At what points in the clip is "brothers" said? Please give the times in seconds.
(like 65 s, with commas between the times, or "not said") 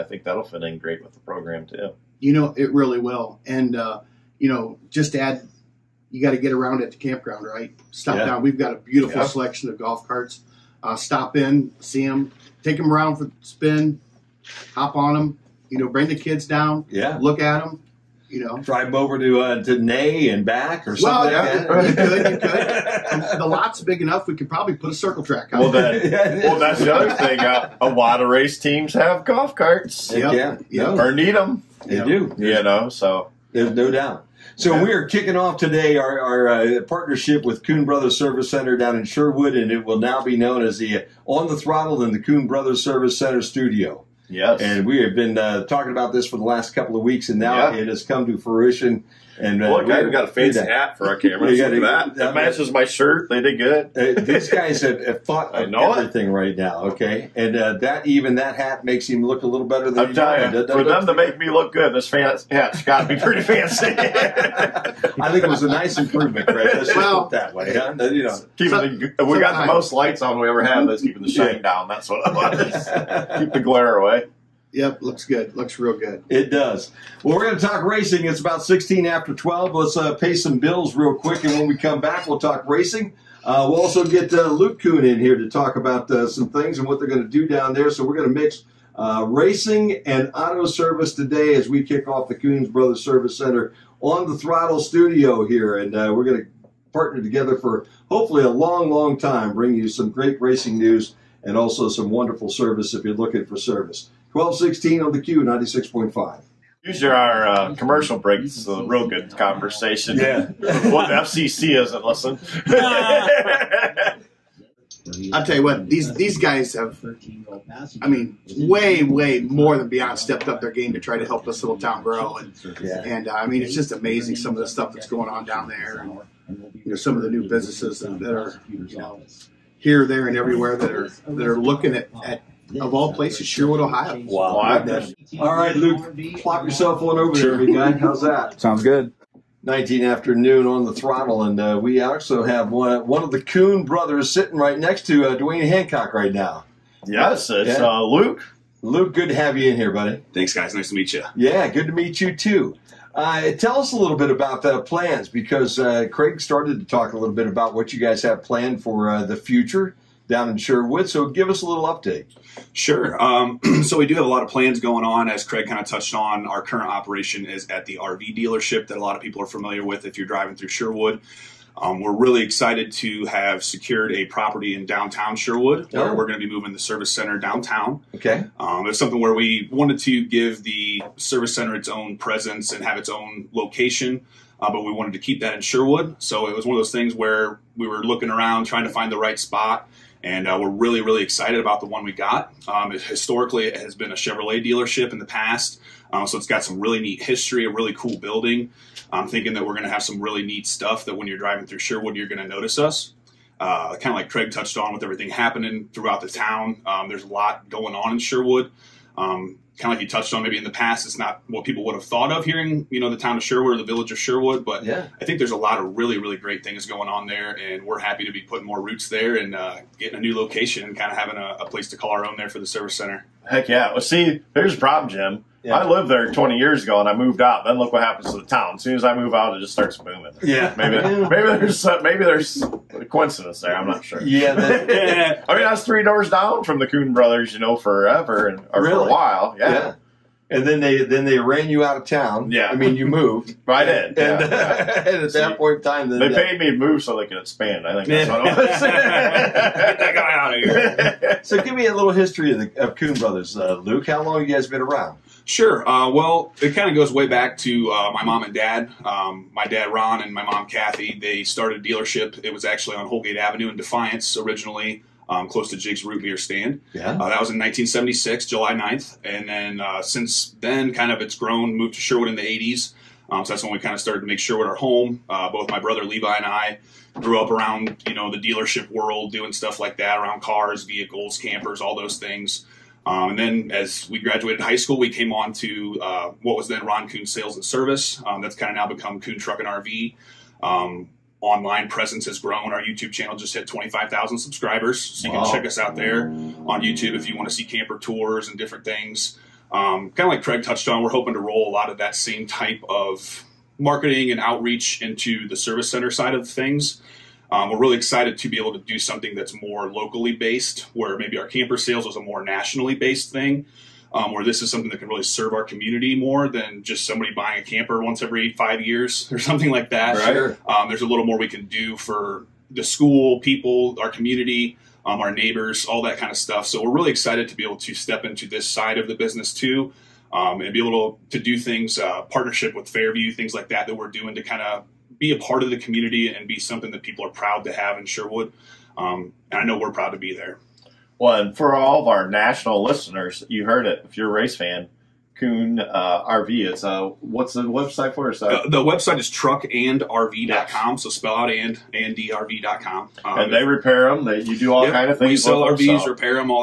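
37 s, 42 s, 92 s, 143 s, 237 s, 253 s, 275 s.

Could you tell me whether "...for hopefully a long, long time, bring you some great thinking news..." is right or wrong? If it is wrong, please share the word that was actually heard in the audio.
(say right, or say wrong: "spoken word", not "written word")
wrong: "racing", not "thinking".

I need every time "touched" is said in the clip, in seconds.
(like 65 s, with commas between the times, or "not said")
165 s, 204 s, 210 s, 300 s.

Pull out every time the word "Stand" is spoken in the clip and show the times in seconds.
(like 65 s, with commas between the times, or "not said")
266 s.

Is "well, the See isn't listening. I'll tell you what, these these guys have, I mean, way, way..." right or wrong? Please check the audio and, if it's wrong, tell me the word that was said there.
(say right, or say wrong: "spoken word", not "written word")
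wrong: "FCC", not "See".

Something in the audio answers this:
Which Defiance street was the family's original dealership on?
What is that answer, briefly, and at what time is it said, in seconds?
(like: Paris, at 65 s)
Holgate Avenue, at 263 s.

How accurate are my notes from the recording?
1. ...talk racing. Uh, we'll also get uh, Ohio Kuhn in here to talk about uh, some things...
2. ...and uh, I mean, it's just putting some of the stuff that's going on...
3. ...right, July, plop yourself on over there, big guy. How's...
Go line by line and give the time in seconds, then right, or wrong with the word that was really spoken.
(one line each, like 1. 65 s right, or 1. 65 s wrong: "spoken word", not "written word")
1. 82 s wrong: "Luke", not "Ohio"
2. 123 s wrong: "amazing", not "putting"
3. 135 s wrong: "Luke", not "July".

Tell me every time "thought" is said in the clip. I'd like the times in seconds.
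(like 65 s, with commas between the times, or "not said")
55 s, 212 s.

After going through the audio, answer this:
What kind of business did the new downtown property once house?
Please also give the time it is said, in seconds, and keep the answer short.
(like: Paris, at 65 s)
Chevrolet dealership, at 194 s.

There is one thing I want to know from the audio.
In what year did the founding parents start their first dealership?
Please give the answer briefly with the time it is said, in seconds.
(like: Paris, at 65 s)
1976, at 267 s.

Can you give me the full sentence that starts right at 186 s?
So it was one of those things where we were looking around trying to find the right spot.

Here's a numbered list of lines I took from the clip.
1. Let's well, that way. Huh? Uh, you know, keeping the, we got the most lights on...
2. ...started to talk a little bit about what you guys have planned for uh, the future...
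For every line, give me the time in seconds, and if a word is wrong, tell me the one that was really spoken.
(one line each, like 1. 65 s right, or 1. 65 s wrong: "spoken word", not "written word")
1. 66 s right
2. 156 s right.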